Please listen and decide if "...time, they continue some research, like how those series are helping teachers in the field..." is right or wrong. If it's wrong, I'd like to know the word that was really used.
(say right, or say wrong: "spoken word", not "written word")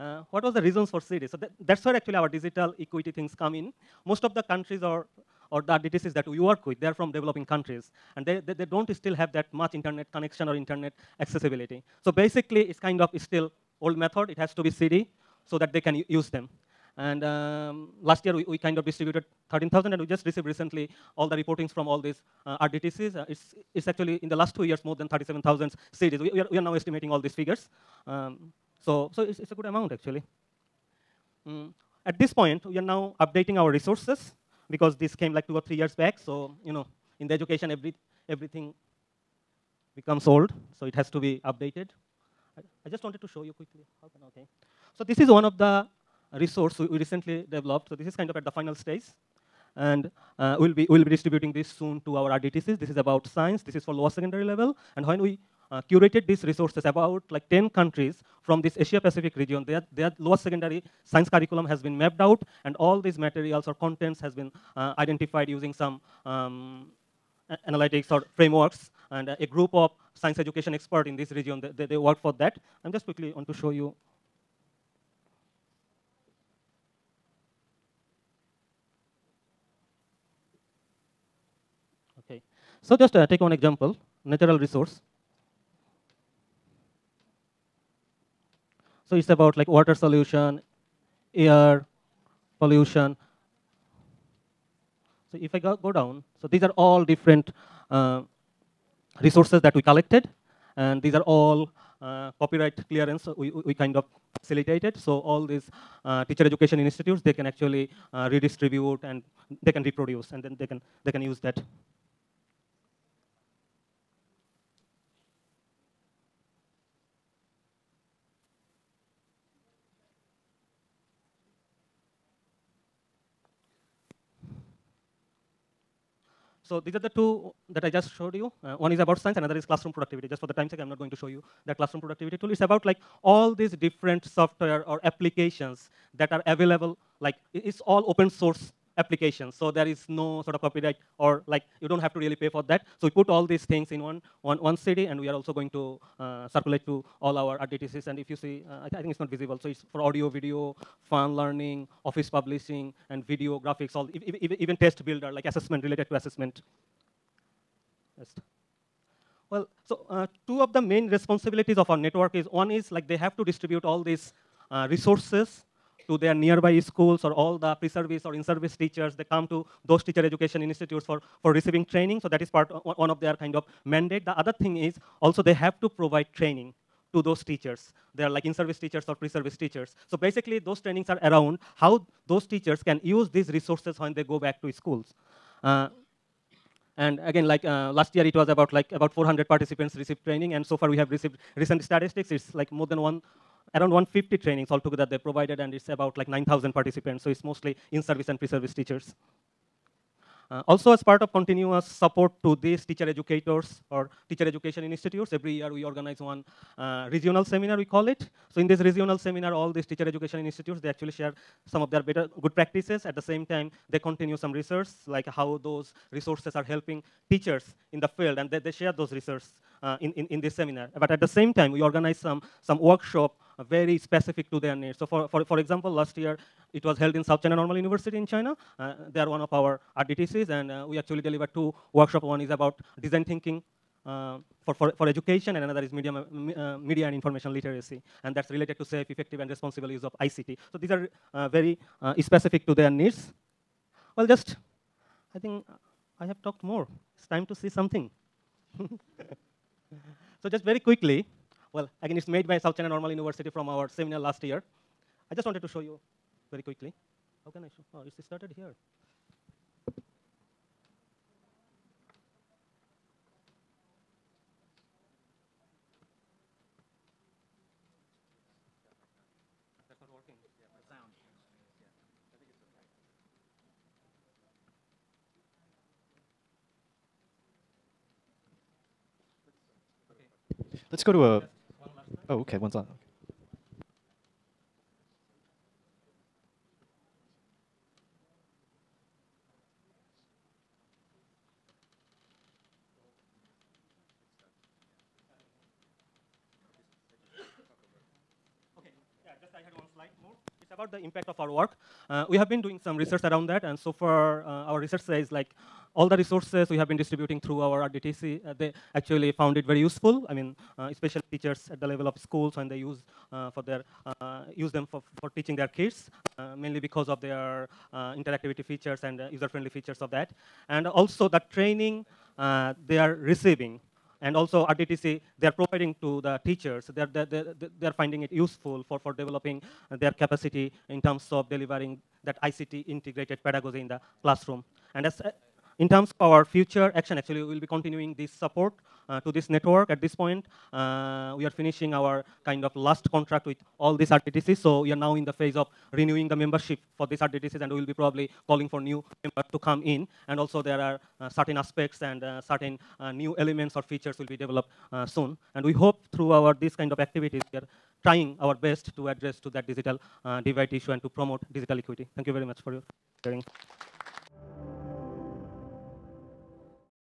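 wrong: "resources", not "series".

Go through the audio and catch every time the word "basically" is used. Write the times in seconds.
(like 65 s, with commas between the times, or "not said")
12 s, 180 s.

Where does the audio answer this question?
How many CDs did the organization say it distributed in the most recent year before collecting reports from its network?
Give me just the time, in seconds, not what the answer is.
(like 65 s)
19 s.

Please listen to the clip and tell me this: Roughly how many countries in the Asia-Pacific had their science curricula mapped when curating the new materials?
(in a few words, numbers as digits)
10.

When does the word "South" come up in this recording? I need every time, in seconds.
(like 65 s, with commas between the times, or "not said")
227 s, 252 s.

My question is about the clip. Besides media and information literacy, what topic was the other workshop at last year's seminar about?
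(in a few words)
design thinking.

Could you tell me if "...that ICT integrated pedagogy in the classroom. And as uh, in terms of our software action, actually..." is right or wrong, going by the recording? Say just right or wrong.
wrong.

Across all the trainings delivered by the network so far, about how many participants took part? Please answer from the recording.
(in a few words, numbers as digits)
9,000.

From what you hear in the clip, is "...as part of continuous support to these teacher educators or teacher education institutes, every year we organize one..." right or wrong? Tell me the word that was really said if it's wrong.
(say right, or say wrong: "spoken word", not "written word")
right.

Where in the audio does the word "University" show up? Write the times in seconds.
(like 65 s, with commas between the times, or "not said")
227 s, 253 s.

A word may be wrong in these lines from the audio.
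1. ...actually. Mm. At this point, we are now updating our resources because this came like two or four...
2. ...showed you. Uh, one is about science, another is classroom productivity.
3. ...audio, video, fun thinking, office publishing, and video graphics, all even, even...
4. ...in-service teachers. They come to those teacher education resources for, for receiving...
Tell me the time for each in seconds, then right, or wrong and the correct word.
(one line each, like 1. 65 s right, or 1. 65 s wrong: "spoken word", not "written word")
1. 29 s wrong: "three", not "four"
2. 128 s right
3. 150 s wrong: "learning", not "thinking"
4. 168 s wrong: "institutes", not "resources".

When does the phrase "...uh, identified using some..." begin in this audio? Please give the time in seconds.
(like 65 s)
64 s.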